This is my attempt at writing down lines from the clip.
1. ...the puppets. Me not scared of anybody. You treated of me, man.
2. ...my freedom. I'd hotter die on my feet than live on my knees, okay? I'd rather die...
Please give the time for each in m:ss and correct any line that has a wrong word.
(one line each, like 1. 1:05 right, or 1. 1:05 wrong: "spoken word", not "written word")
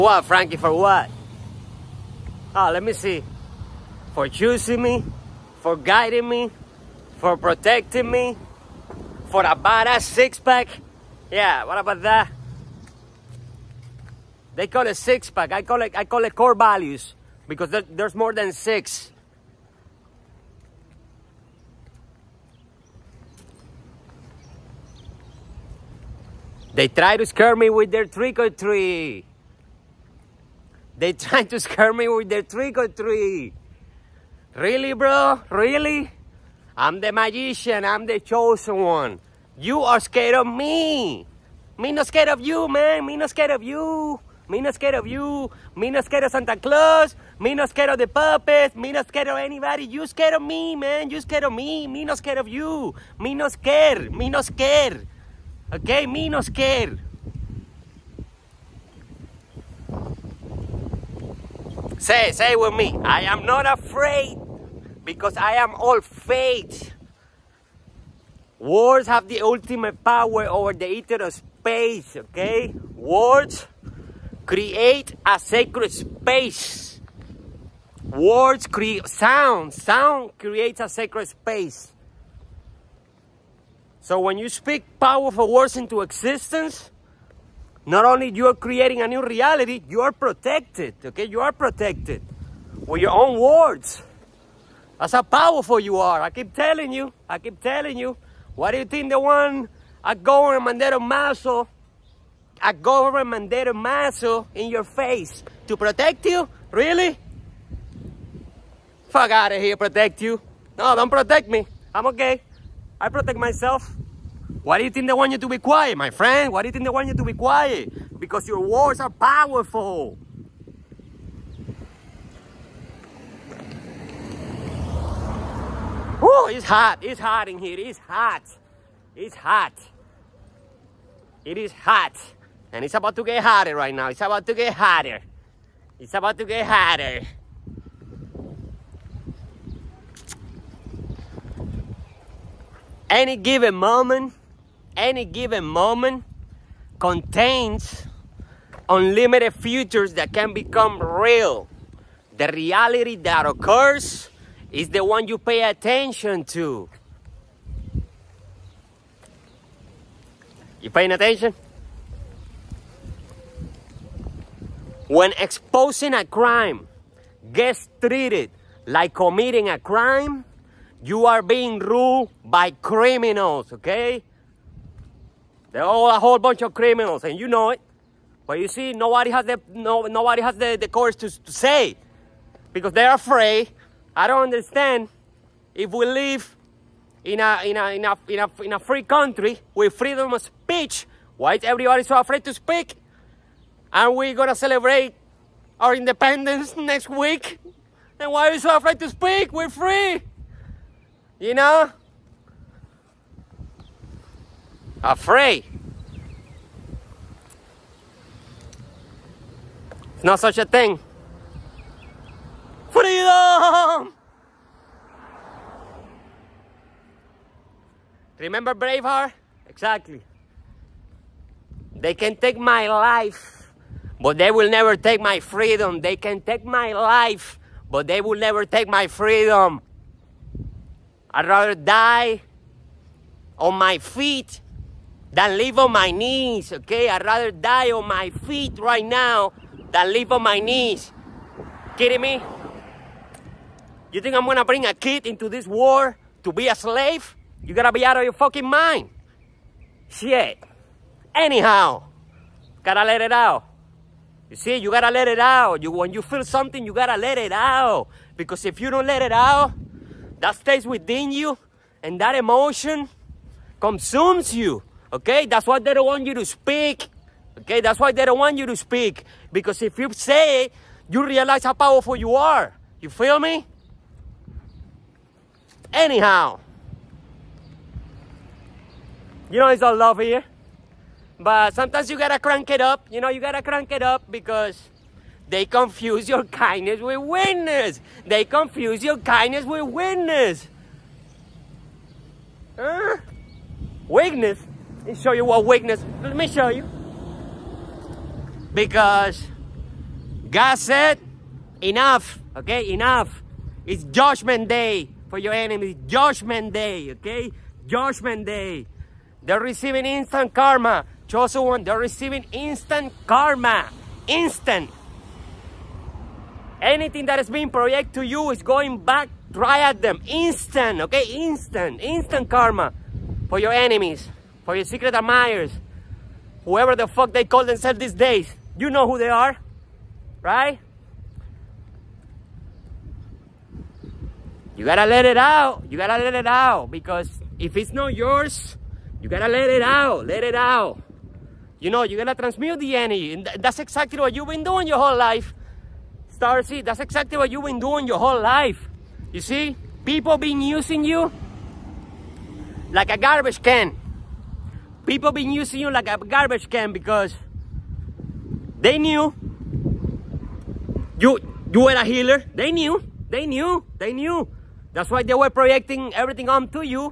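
1. 0:47 wrong: "scared", not "treated"
2. 3:48 wrong: "rather", not "hotter".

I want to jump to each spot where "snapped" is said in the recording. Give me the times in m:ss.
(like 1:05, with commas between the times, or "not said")
not said.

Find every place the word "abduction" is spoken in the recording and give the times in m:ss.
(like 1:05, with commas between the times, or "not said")
not said.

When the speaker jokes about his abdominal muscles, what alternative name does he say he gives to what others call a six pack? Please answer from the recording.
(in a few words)
core values.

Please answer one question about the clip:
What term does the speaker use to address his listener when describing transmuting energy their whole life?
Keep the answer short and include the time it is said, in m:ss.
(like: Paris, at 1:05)
Starseed, at 5:46.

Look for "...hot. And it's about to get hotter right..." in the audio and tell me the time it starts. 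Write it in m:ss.
2:11.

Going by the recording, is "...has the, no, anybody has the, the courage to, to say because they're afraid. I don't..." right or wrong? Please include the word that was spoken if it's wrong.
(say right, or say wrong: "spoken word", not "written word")
wrong: "nobody", not "anybody".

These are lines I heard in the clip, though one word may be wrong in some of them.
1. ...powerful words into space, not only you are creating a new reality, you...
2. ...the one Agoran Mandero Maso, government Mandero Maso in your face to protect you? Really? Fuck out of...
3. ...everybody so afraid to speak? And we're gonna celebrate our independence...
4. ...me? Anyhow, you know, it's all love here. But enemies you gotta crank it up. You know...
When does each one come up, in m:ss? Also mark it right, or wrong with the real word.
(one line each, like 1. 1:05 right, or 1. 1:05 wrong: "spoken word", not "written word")
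1. 1:25 wrong: "existence", not "space"
2. 1:39 right
3. 3:11 right
4. 4:33 wrong: "sometimes", not "enemies".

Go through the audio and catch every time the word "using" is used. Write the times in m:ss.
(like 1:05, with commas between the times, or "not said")
5:50, 5:55.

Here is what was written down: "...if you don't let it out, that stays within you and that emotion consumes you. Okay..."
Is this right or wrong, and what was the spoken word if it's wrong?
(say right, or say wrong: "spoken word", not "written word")
right.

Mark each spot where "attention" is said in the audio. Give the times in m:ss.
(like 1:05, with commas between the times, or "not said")
2:35, 2:41.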